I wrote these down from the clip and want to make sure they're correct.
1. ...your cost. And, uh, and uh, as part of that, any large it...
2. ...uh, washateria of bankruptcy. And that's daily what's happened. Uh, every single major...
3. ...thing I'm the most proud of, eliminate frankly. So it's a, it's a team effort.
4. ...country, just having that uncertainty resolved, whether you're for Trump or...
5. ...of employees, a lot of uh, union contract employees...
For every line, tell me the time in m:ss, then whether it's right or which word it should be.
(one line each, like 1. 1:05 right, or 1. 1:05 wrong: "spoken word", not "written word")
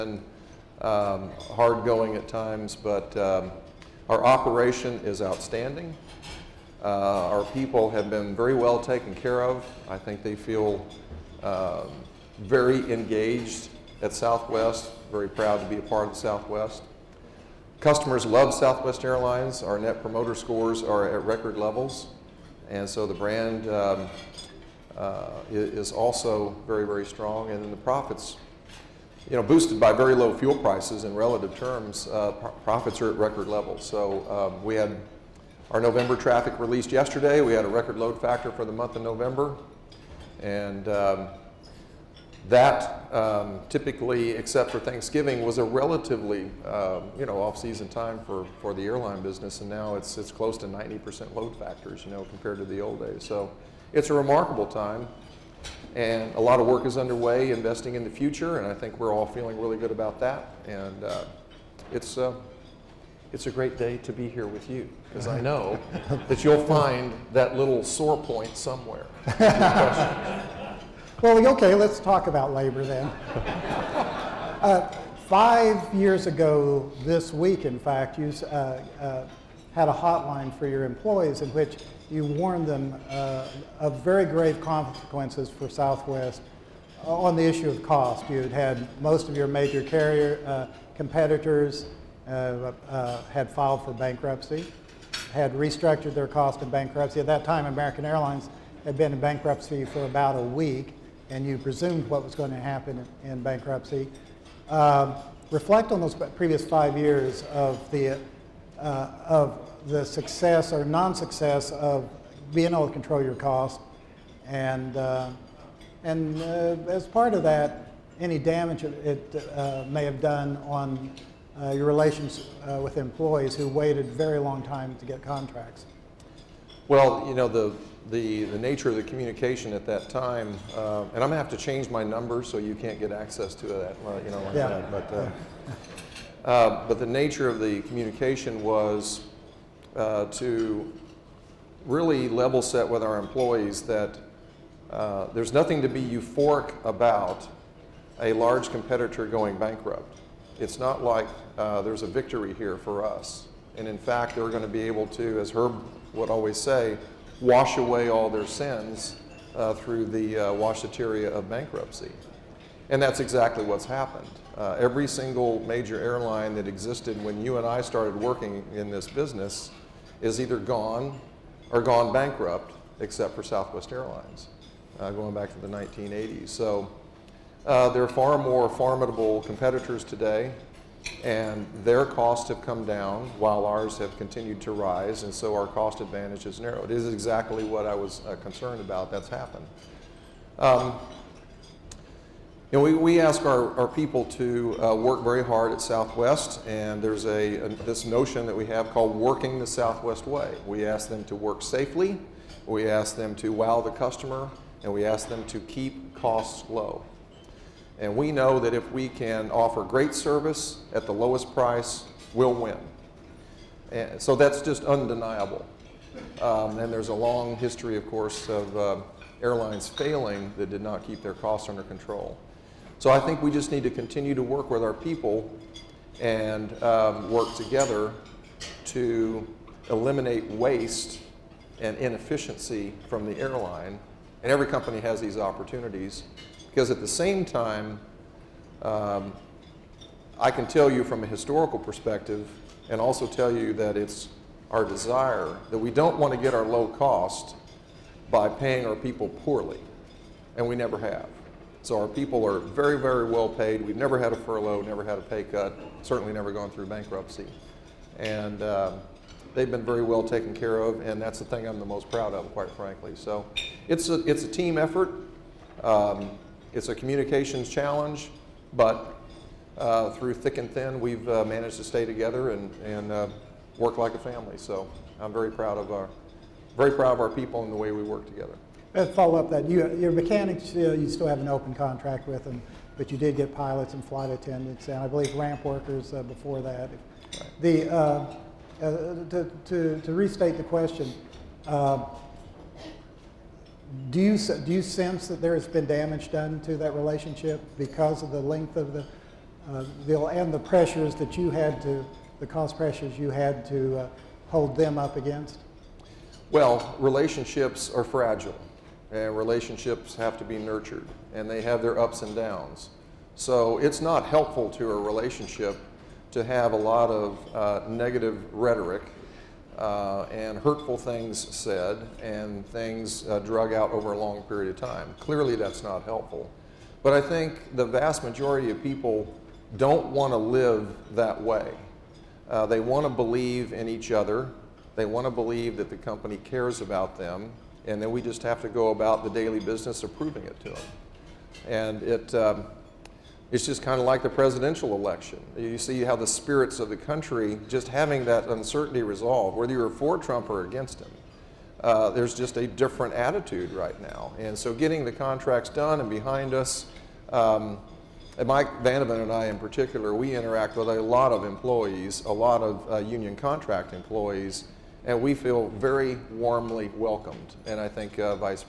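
1. 1:53 wrong: "damage", not "large"
2. 2:40 wrong: "exactly", not "daily"
3. 4:21 wrong: "quite", not "eliminate"
4. 5:46 right
5. 6:01 right.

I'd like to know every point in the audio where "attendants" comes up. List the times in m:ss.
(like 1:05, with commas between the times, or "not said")
4:44.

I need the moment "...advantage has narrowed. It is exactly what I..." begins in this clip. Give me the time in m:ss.
3:06.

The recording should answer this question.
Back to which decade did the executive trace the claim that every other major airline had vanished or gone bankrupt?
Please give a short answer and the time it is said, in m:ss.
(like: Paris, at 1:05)
1980s, at 2:55.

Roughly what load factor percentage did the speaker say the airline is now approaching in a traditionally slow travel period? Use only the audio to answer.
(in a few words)
90%.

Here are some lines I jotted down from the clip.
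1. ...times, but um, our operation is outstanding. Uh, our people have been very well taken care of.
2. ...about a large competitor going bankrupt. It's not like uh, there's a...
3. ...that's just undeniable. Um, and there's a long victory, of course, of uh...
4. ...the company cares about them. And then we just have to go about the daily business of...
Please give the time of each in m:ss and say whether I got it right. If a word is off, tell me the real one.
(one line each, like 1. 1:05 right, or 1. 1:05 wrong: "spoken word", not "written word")
1. 0:02 right
2. 2:26 right
3. 3:34 wrong: "history", not "victory"
4. 5:35 right.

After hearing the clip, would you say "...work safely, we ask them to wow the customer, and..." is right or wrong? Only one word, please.
right.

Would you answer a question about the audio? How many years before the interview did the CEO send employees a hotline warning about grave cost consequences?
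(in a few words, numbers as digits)
5.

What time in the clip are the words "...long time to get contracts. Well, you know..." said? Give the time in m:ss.
2:04.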